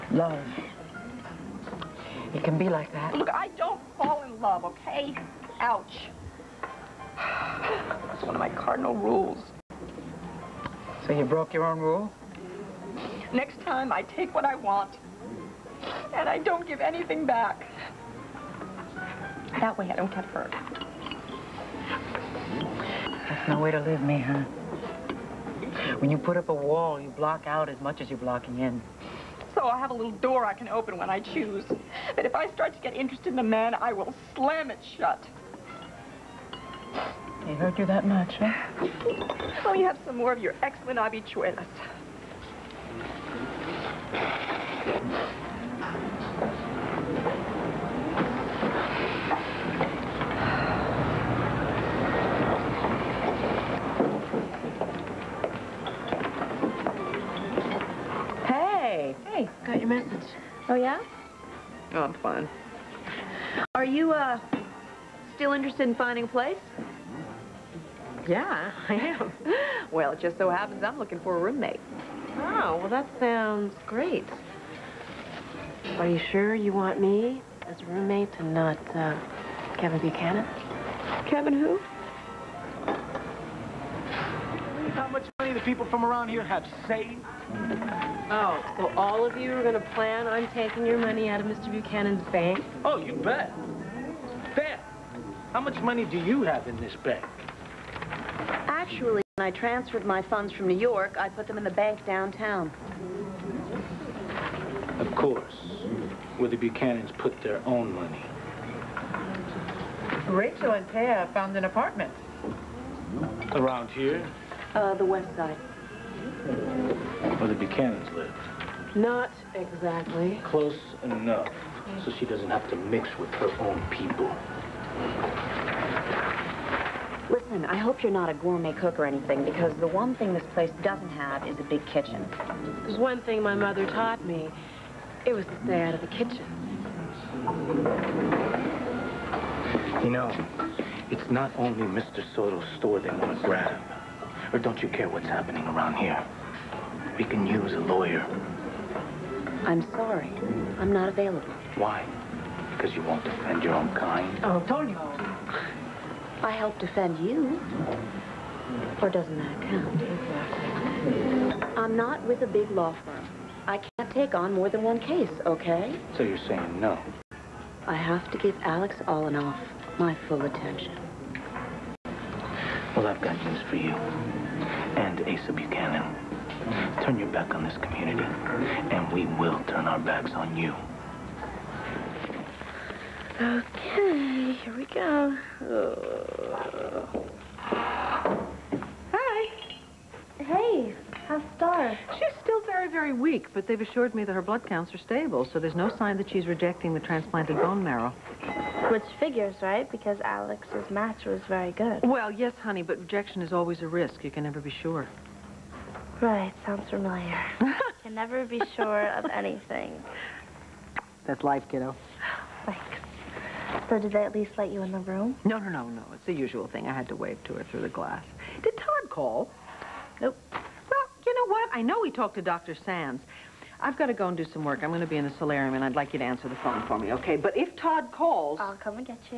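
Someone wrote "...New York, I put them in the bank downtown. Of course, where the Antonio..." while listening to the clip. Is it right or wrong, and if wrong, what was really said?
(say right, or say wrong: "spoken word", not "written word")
wrong: "Buchanans", not "Antonio".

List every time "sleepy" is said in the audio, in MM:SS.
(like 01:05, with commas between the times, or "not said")
not said.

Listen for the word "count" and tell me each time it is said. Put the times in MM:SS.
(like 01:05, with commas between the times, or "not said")
02:39, 03:14.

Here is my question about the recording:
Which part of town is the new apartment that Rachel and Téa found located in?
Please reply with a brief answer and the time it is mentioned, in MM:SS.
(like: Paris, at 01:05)
the west side, at 01:54.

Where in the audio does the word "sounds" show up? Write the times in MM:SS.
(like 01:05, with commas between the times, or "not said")
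01:13, 03:26.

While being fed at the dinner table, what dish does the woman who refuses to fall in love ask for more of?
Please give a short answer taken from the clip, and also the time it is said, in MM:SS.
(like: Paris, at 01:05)
habichuelas, at 00:40.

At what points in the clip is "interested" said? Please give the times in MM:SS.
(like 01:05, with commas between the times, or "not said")
00:32, 01:05.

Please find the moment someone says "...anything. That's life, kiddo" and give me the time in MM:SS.
03:29.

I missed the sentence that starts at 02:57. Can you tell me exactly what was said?
Turn your back on this community, and we will turn our backs on you.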